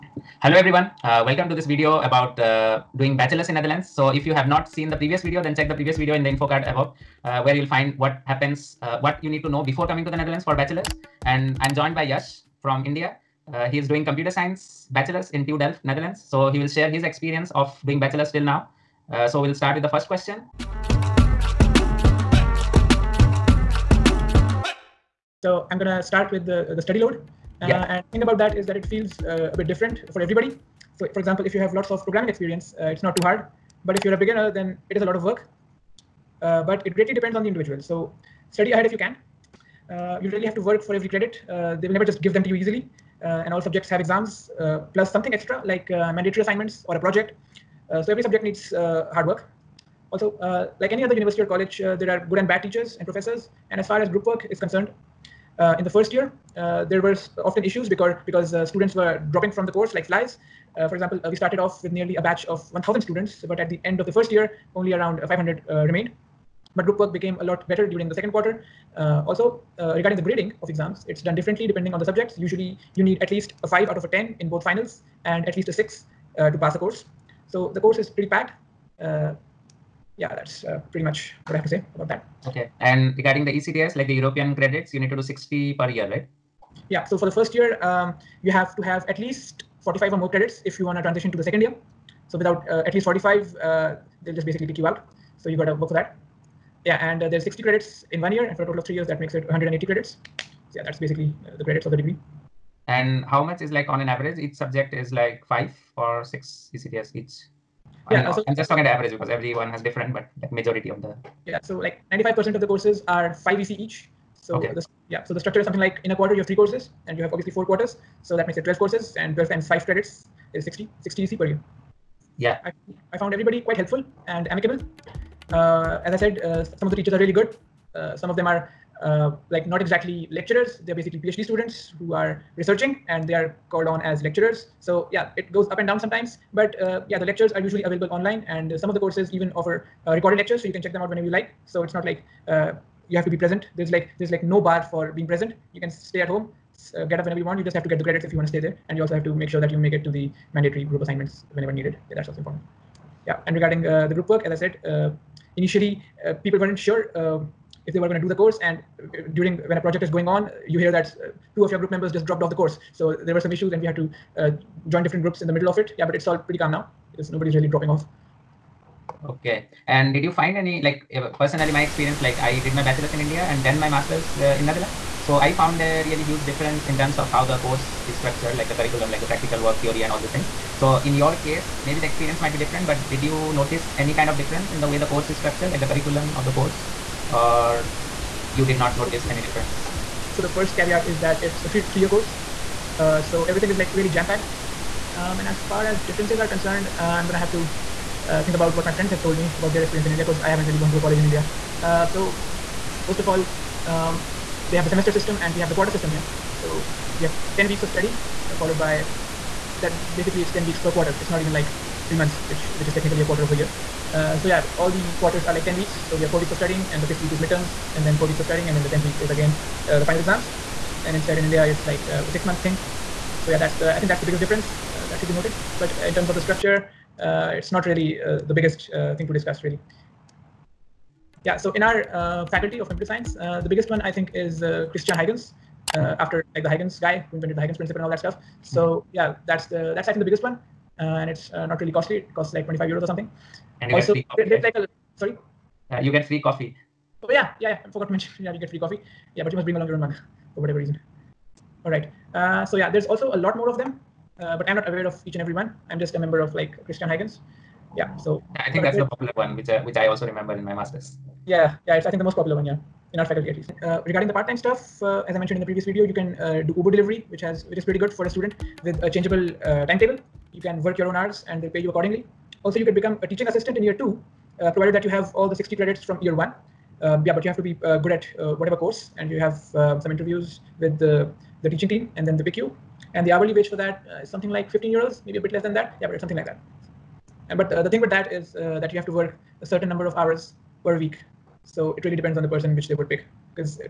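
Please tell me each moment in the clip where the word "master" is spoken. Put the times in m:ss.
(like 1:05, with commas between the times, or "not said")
2:53, 4:20.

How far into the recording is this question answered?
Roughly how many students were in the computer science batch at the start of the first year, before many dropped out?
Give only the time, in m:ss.
1:02.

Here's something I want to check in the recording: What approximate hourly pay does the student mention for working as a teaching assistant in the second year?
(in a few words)
15 euros.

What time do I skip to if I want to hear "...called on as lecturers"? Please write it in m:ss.
2:13.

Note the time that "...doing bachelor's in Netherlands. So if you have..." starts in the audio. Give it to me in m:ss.
0:02.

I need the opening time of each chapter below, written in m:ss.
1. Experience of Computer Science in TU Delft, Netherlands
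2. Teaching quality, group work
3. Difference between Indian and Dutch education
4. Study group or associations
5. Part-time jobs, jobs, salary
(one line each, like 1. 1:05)
1. 0:25
2. 2:02
3. 2:49
4. 3:50
5. 4:23.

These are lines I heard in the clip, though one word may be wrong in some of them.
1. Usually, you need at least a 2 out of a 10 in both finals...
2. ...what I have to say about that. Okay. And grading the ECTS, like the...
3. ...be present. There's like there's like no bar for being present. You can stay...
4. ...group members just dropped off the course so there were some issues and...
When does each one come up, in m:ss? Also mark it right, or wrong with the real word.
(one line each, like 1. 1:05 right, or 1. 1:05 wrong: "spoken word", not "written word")
1. 1:12 wrong: "5", not "2"
2. 1:21 wrong: "regarding", not "grading"
3. 2:23 right
4. 2:41 right.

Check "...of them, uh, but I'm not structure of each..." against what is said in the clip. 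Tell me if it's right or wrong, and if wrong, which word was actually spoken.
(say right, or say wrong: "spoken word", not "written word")
wrong: "aware", not "structure".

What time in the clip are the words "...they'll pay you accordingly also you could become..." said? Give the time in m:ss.
4:31.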